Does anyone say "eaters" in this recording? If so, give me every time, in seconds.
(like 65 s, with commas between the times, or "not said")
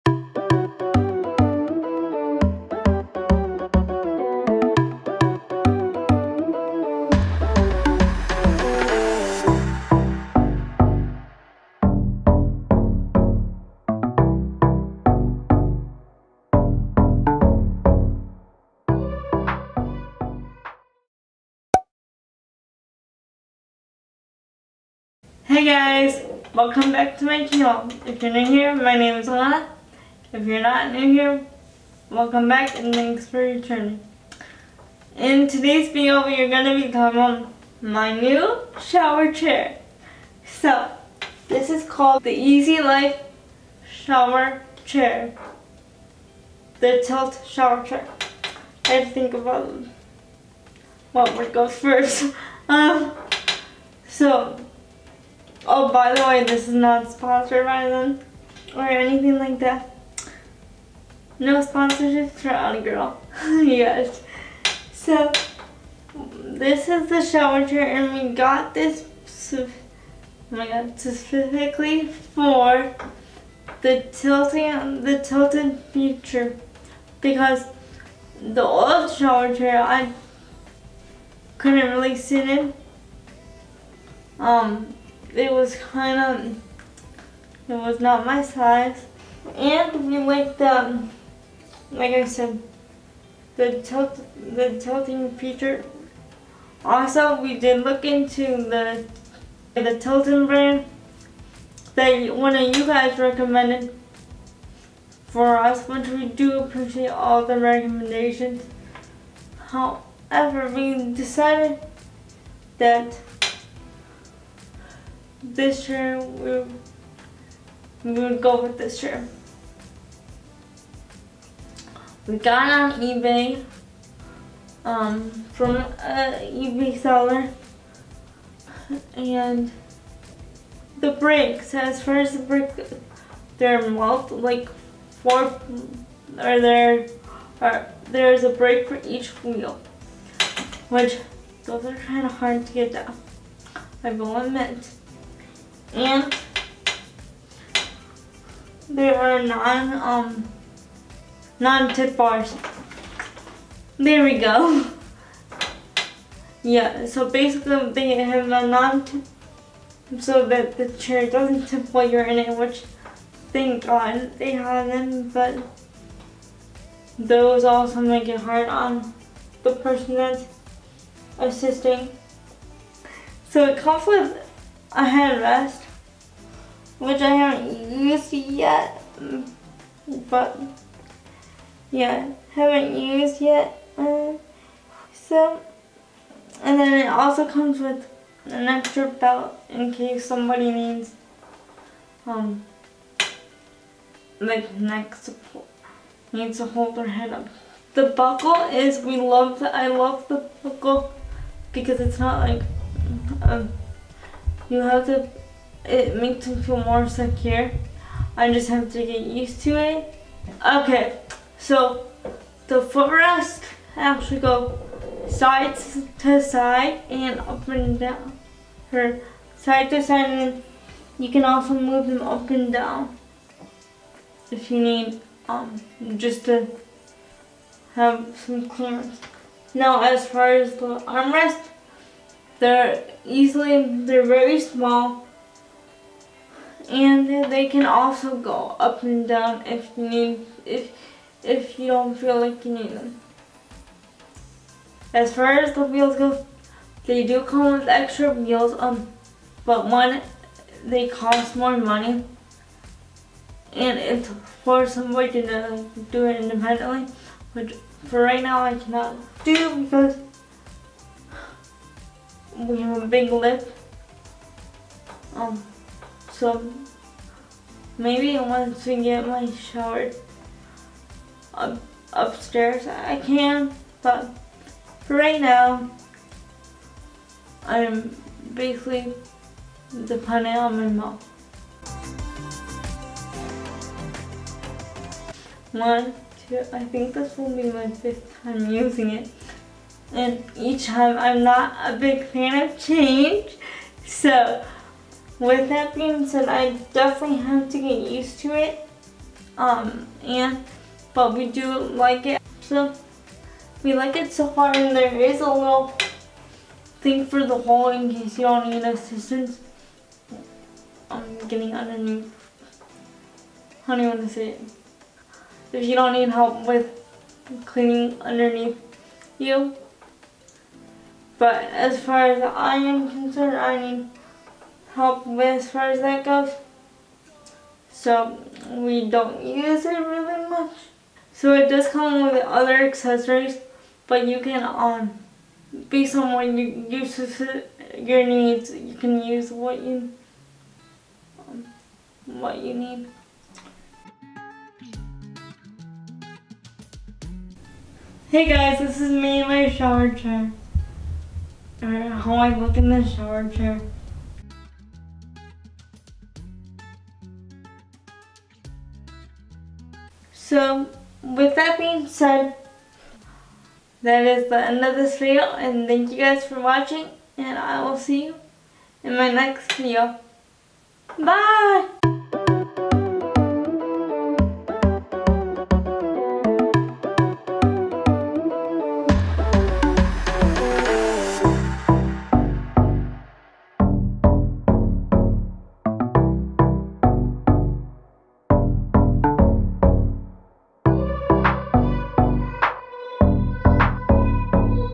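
not said.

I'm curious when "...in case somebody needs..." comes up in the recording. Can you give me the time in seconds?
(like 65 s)
189 s.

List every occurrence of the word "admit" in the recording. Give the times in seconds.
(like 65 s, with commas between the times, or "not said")
144 s.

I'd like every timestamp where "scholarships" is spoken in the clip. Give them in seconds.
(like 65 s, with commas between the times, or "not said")
not said.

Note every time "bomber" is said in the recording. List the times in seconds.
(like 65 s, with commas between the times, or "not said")
not said.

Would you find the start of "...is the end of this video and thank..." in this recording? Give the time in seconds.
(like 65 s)
364 s.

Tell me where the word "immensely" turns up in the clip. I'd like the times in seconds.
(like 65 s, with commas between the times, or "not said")
not said.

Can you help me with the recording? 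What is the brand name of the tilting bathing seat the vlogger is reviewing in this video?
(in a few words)
EZeeLife.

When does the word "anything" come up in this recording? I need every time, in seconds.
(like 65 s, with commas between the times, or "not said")
58 s.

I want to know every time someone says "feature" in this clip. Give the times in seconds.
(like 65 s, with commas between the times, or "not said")
75 s, 95 s.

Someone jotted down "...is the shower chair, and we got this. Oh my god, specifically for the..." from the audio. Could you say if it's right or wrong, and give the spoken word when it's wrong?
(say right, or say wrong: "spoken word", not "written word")
right.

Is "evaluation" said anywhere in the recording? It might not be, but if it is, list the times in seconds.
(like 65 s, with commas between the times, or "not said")
not said.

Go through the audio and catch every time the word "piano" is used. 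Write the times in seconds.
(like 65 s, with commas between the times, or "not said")
not said.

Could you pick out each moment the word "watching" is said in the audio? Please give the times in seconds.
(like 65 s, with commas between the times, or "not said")
366 s.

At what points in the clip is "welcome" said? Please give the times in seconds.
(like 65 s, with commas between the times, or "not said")
26 s, 32 s.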